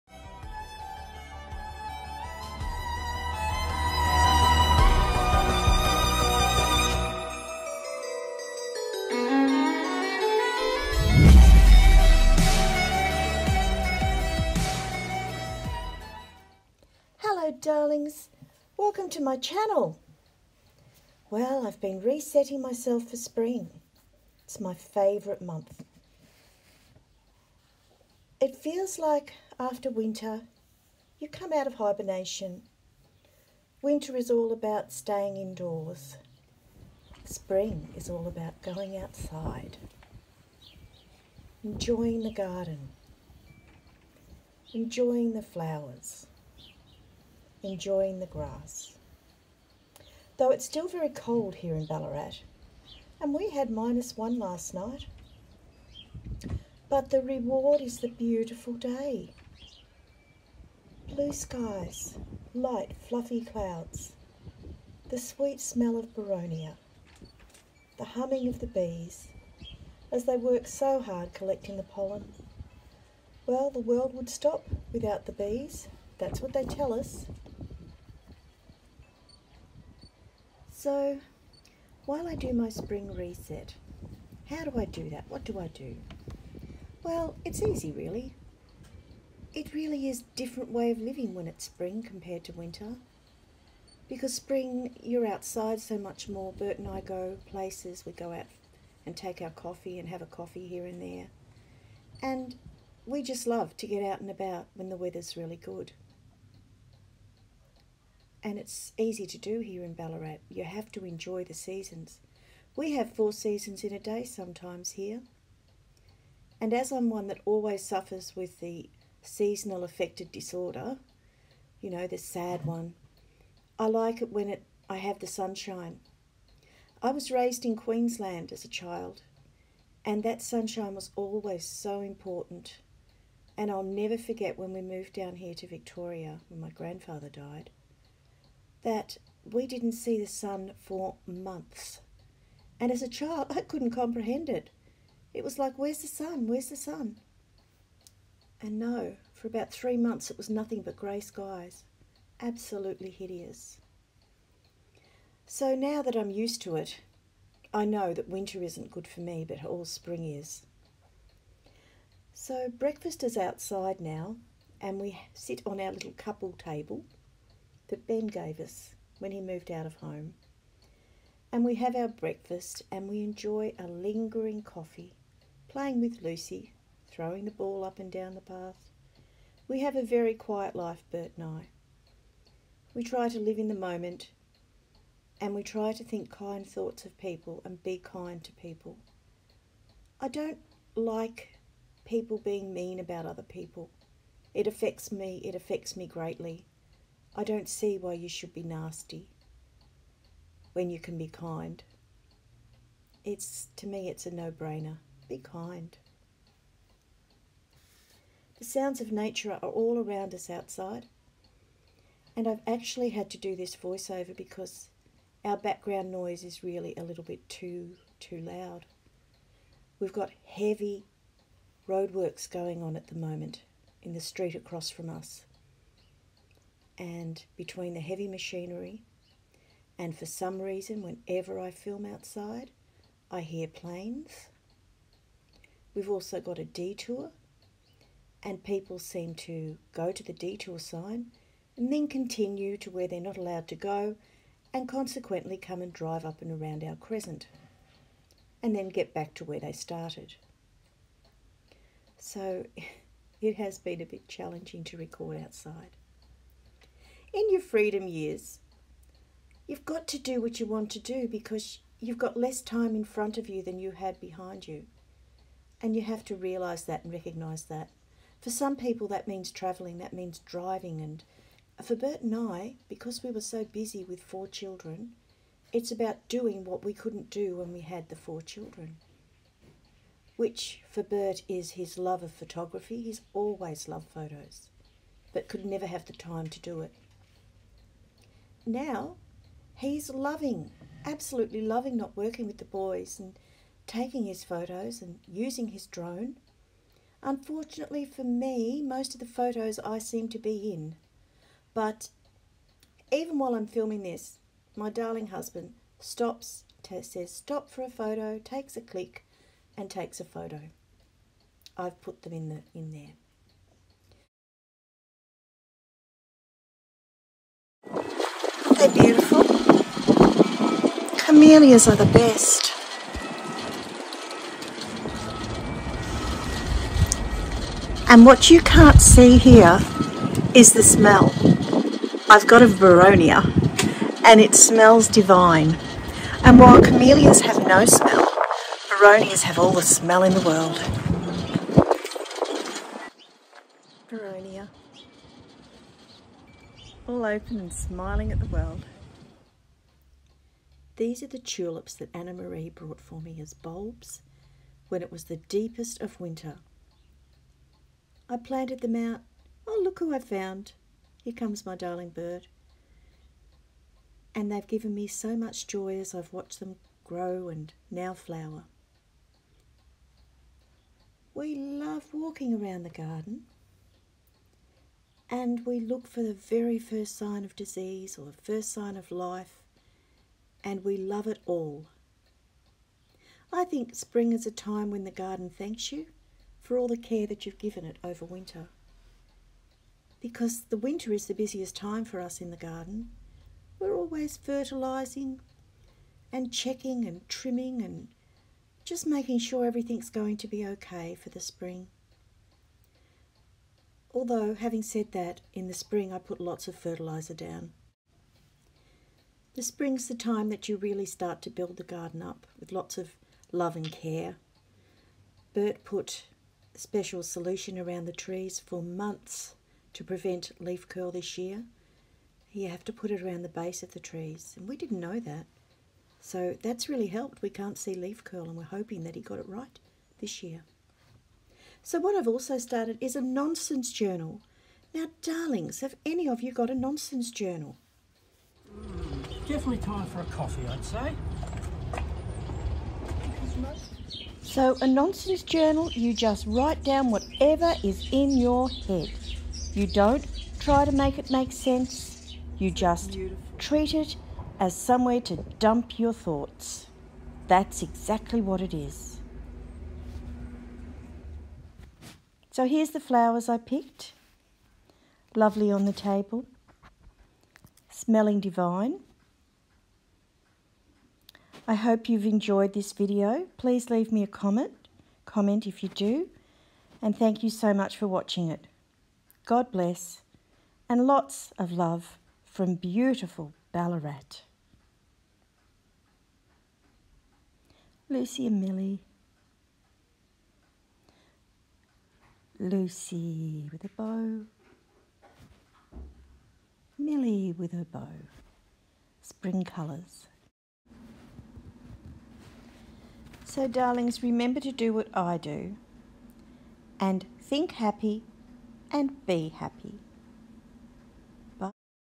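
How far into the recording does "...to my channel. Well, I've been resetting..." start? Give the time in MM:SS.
00:19.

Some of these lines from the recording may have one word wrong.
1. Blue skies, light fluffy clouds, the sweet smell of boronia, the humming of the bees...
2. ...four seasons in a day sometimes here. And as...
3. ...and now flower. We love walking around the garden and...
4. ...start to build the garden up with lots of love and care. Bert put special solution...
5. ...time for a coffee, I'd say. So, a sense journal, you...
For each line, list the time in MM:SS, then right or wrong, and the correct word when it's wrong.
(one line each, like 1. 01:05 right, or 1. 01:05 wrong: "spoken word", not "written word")
1. 01:01 right
2. 01:53 right
3. 06:07 right
4. 06:51 right
5. 07:19 wrong: "nonsense", not "sense".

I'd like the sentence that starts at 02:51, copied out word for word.
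And we have our breakfast and we enjoy a lingering coffee, playing with Lucy, throwing the ball up and down the path.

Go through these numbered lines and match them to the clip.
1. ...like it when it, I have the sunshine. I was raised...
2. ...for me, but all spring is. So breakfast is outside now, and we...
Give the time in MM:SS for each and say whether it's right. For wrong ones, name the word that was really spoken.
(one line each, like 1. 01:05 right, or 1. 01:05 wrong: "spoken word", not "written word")
1. 02:03 right
2. 02:39 right.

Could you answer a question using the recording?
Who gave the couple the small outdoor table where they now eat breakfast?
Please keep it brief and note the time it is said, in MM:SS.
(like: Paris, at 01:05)
Ben, at 02:48.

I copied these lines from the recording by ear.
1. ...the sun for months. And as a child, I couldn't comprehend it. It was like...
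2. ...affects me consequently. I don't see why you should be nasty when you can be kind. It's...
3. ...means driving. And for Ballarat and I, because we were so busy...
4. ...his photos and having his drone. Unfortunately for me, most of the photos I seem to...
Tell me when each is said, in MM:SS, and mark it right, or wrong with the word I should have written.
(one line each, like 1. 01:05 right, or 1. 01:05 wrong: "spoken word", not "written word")
1. 02:20 right
2. 03:15 wrong: "greatly", not "consequently"
3. 04:30 wrong: "Bert", not "Ballarat"
4. 04:54 wrong: "using", not "having".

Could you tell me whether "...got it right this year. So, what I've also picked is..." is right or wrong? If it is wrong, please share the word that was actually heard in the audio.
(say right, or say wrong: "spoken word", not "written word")
wrong: "started", not "picked".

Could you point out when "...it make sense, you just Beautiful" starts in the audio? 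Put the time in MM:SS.
07:31.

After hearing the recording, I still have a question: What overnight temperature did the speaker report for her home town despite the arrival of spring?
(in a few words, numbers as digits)
-1.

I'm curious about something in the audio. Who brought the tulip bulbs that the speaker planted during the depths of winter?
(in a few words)
Anna Marie.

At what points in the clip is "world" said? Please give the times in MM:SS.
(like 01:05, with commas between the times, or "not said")
01:13, 05:40, 05:48.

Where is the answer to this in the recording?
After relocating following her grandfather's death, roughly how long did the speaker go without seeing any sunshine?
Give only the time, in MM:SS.
02:29.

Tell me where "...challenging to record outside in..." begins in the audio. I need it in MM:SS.
04:14.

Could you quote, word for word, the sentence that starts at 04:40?
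Which for Bert is his love of photography.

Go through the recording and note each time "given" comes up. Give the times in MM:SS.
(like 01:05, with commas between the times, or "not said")
06:04, 06:27.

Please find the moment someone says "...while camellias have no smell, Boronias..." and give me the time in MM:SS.
05:36.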